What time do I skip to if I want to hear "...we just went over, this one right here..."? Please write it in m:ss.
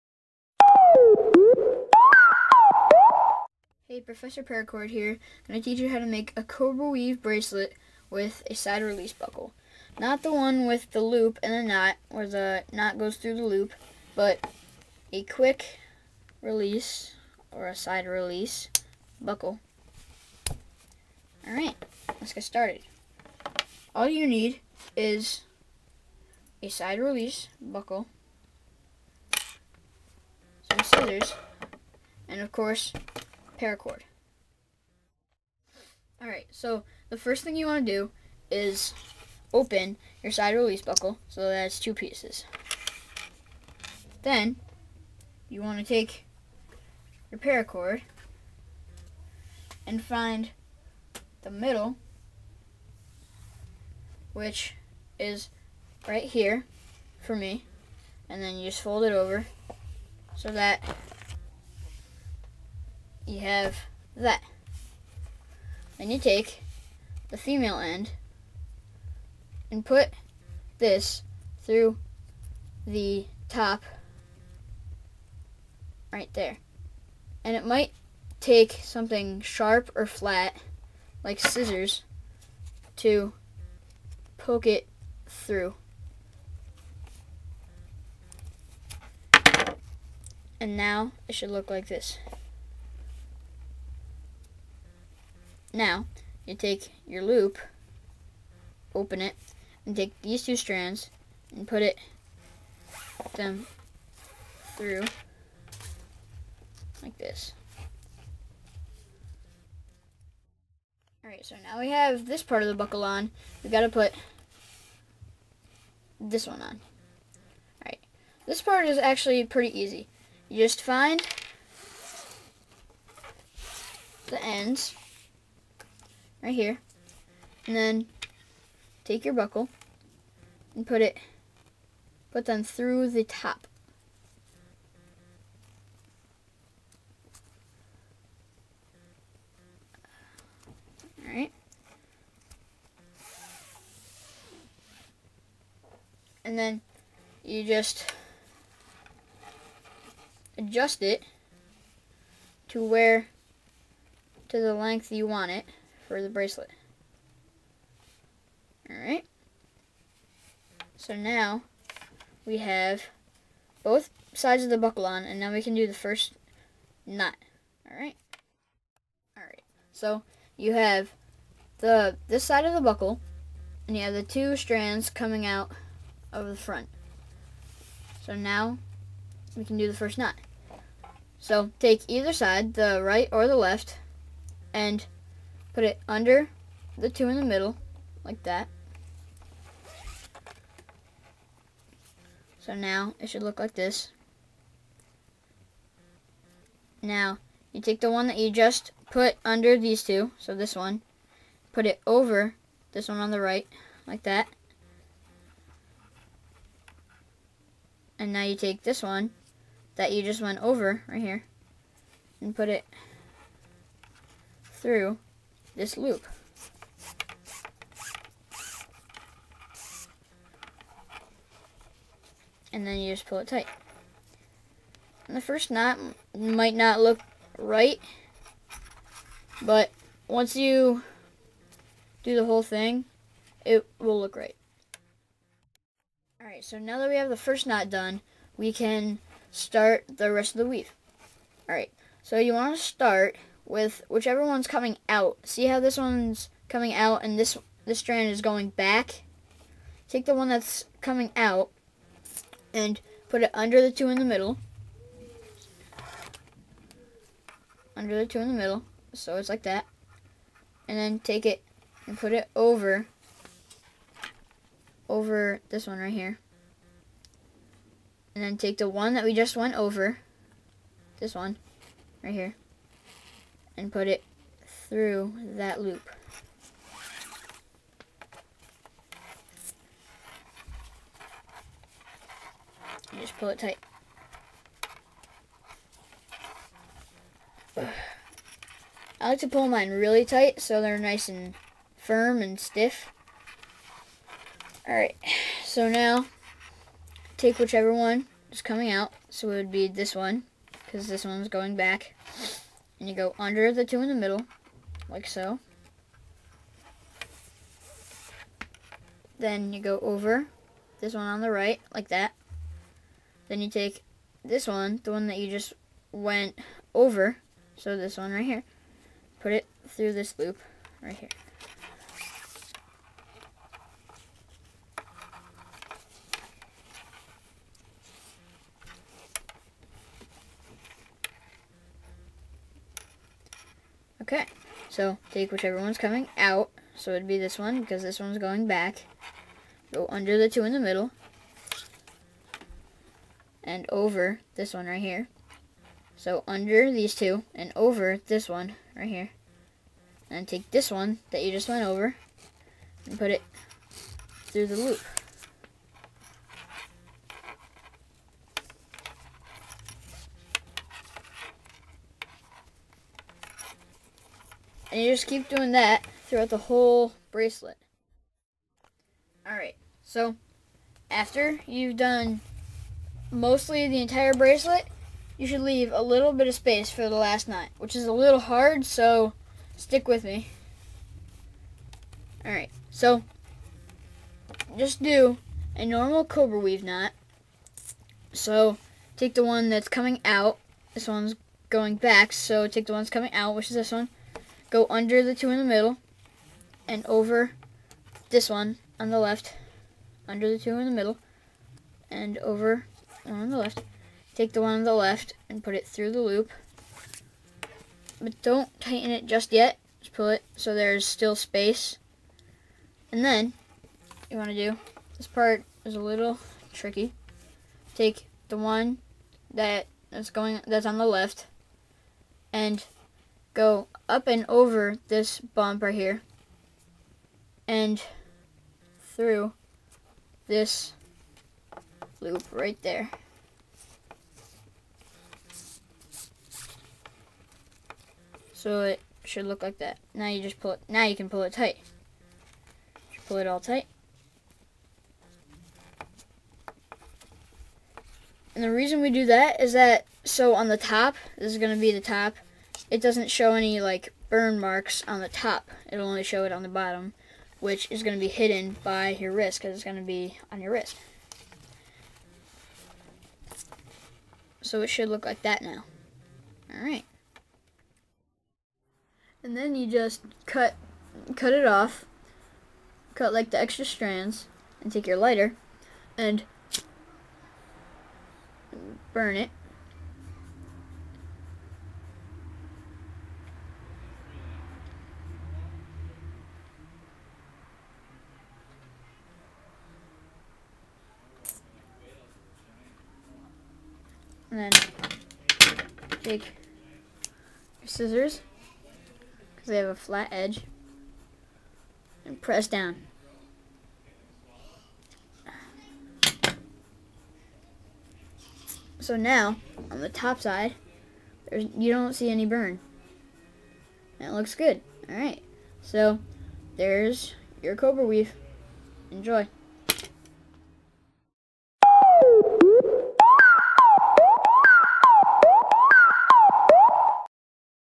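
4:29.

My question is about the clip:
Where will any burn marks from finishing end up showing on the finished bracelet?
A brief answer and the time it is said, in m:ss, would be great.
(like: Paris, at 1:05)
the bottom, at 7:36.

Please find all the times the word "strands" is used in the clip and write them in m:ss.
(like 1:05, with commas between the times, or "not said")
1:40, 2:54, 4:07, 7:53.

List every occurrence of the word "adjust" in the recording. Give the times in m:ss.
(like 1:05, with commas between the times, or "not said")
2:30.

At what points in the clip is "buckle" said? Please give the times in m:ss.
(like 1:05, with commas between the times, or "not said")
0:09, 0:19, 0:27, 0:40, 1:52, 2:09, 2:44, 2:52.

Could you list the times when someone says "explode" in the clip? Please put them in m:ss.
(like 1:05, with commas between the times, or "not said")
not said.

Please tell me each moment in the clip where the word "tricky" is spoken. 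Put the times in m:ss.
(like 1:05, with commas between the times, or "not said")
6:56.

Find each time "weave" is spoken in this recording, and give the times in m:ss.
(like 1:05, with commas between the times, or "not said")
0:06, 4:00, 6:26, 8:38.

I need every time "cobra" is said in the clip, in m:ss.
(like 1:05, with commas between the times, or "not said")
0:06, 6:26, 8:37.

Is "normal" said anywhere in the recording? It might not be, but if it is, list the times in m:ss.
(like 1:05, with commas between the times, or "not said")
6:25.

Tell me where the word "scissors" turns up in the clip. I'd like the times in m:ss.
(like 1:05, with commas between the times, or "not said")
0:30, 1:21, 8:17.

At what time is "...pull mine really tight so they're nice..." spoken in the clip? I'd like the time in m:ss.
4:49.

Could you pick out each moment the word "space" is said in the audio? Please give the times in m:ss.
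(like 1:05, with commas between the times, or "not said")
6:16, 6:51.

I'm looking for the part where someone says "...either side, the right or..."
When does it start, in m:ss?
3:02.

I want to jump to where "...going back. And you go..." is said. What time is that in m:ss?
5:01.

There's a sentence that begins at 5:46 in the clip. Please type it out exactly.
So under these two and over this one right here.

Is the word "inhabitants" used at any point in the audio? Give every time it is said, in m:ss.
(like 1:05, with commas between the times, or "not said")
not said.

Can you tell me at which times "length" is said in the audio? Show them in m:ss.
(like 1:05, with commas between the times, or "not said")
2:34.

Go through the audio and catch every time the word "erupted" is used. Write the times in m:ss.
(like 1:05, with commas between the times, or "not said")
not said.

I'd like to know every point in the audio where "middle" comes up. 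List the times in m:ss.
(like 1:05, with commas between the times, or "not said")
0:51, 3:07, 4:14, 4:18, 5:04, 5:40, 6:35, 6:40.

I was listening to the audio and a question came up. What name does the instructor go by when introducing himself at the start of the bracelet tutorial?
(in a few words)
Professor Paracord.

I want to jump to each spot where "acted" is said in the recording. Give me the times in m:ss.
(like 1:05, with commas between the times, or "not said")
not said.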